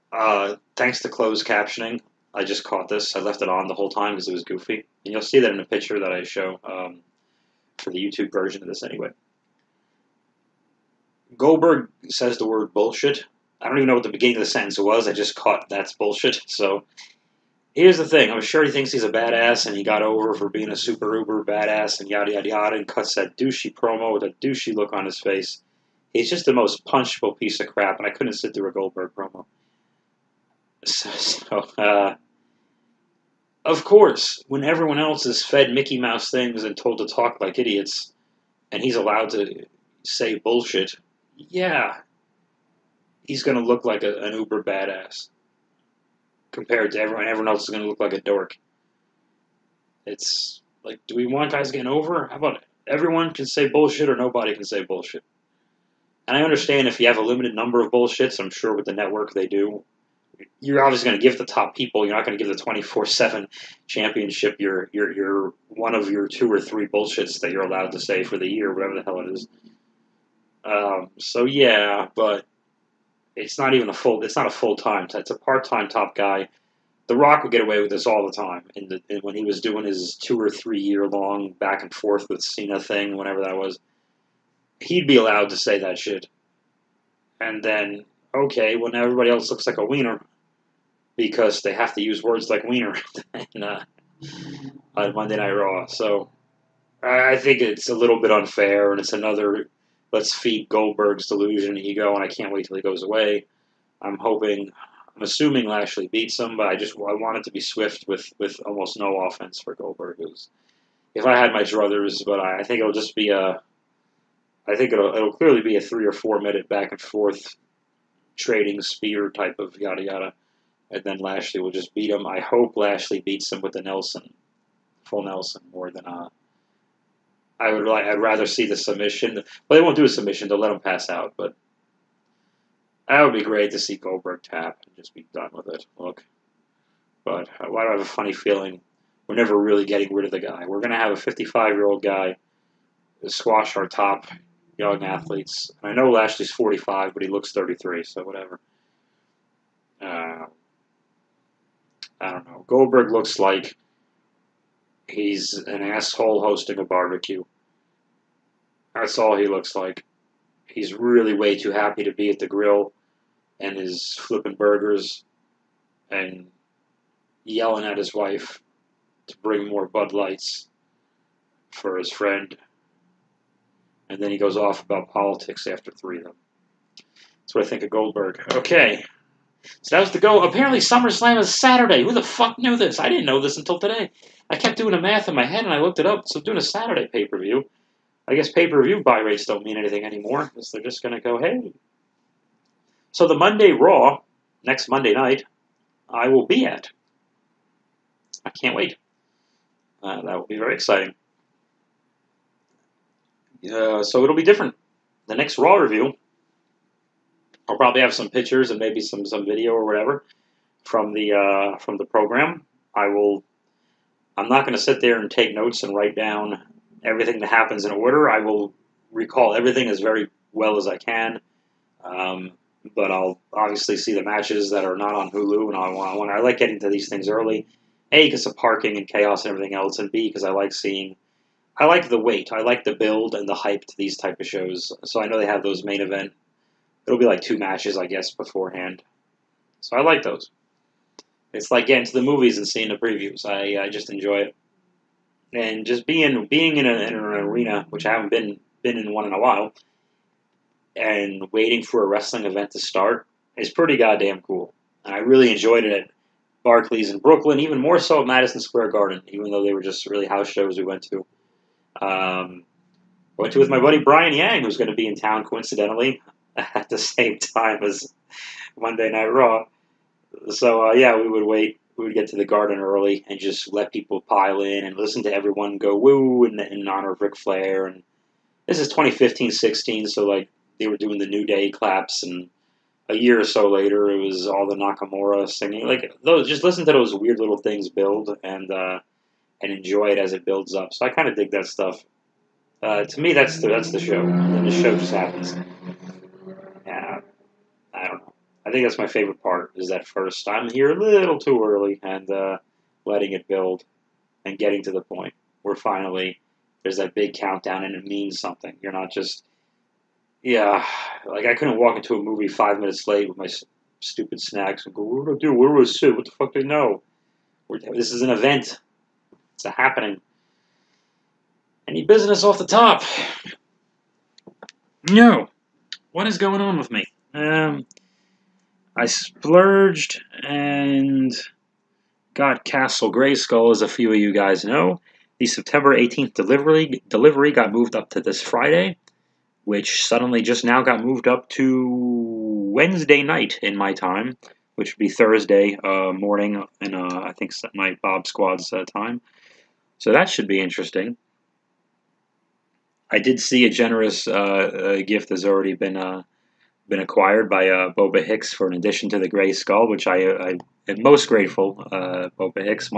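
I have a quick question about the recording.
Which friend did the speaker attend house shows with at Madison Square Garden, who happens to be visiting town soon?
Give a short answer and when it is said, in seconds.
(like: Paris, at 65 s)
Brian Yang, at 264 s.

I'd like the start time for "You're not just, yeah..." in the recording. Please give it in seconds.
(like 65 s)
308 s.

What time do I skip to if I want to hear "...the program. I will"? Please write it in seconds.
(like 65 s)
211 s.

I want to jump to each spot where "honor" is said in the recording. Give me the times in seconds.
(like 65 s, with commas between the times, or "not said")
276 s.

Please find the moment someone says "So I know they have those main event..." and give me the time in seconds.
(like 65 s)
235 s.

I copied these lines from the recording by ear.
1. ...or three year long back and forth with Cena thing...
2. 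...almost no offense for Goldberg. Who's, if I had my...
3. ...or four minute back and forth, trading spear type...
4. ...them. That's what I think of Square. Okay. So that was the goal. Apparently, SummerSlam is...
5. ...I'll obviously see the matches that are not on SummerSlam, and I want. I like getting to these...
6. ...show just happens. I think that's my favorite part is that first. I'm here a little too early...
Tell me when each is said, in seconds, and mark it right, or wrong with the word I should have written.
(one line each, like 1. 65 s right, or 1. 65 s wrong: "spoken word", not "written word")
1. 80 s right
2. 108 s right
3. 116 s right
4. 176 s wrong: "Goldberg", not "Square"
5. 223 s wrong: "Hulu", not "SummerSlam"
6. 294 s right.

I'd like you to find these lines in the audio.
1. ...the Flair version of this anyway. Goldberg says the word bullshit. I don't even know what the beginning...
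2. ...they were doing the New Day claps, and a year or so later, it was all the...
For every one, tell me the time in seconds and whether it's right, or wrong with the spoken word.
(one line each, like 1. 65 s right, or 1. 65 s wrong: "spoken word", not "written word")
1. 7 s wrong: "YouTube", not "Flair"
2. 280 s right.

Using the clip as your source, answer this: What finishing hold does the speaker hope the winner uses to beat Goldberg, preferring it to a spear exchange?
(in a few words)
Full Nelson.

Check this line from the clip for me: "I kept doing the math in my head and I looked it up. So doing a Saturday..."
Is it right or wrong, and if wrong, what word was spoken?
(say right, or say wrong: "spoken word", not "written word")
right.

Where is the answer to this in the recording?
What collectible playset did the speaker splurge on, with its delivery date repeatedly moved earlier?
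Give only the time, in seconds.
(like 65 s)
332 s.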